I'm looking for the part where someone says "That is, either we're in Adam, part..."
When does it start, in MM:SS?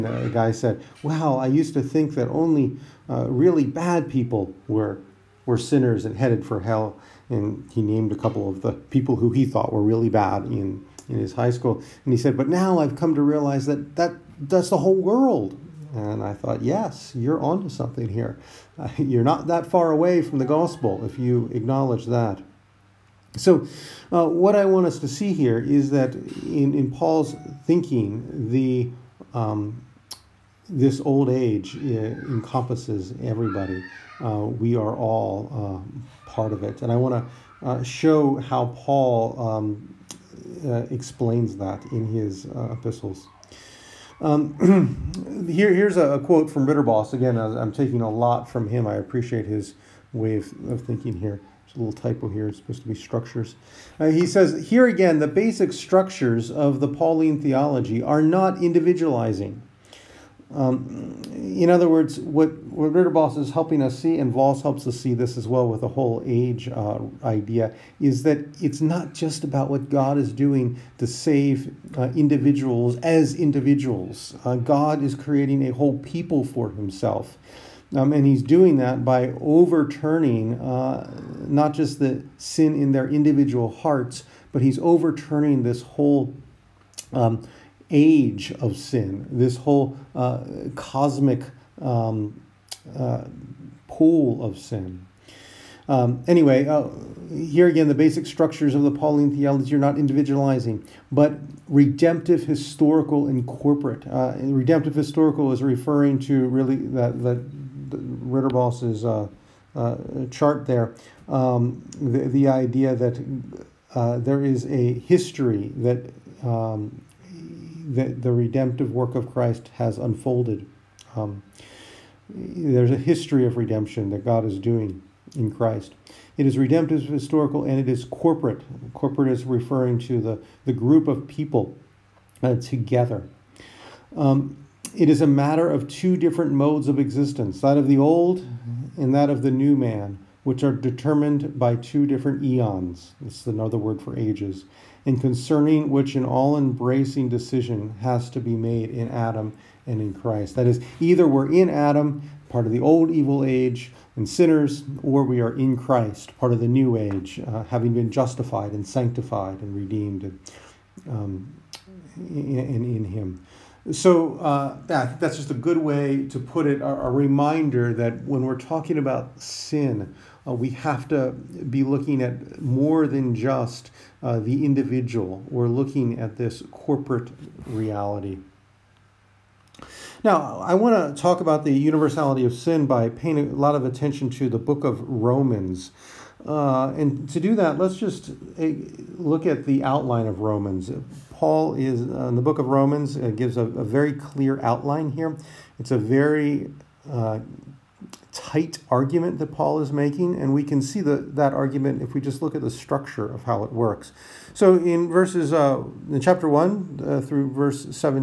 02:30.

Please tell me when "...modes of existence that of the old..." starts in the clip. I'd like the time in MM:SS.
02:16.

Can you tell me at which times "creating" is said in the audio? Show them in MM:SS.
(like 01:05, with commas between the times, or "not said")
01:15.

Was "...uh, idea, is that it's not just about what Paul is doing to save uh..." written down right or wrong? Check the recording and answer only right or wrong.
wrong.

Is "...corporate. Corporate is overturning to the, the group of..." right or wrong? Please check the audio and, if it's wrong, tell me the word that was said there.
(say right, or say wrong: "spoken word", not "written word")
wrong: "referring", not "overturning".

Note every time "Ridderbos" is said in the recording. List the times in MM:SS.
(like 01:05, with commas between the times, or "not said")
01:02, 01:47.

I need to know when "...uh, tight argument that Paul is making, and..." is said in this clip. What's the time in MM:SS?
03:17.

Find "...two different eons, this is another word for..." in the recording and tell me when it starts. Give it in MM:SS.
02:21.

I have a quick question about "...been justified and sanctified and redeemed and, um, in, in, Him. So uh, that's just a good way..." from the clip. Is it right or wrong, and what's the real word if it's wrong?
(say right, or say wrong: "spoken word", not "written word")
right.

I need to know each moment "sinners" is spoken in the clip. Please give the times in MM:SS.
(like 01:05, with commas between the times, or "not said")
00:05, 02:34.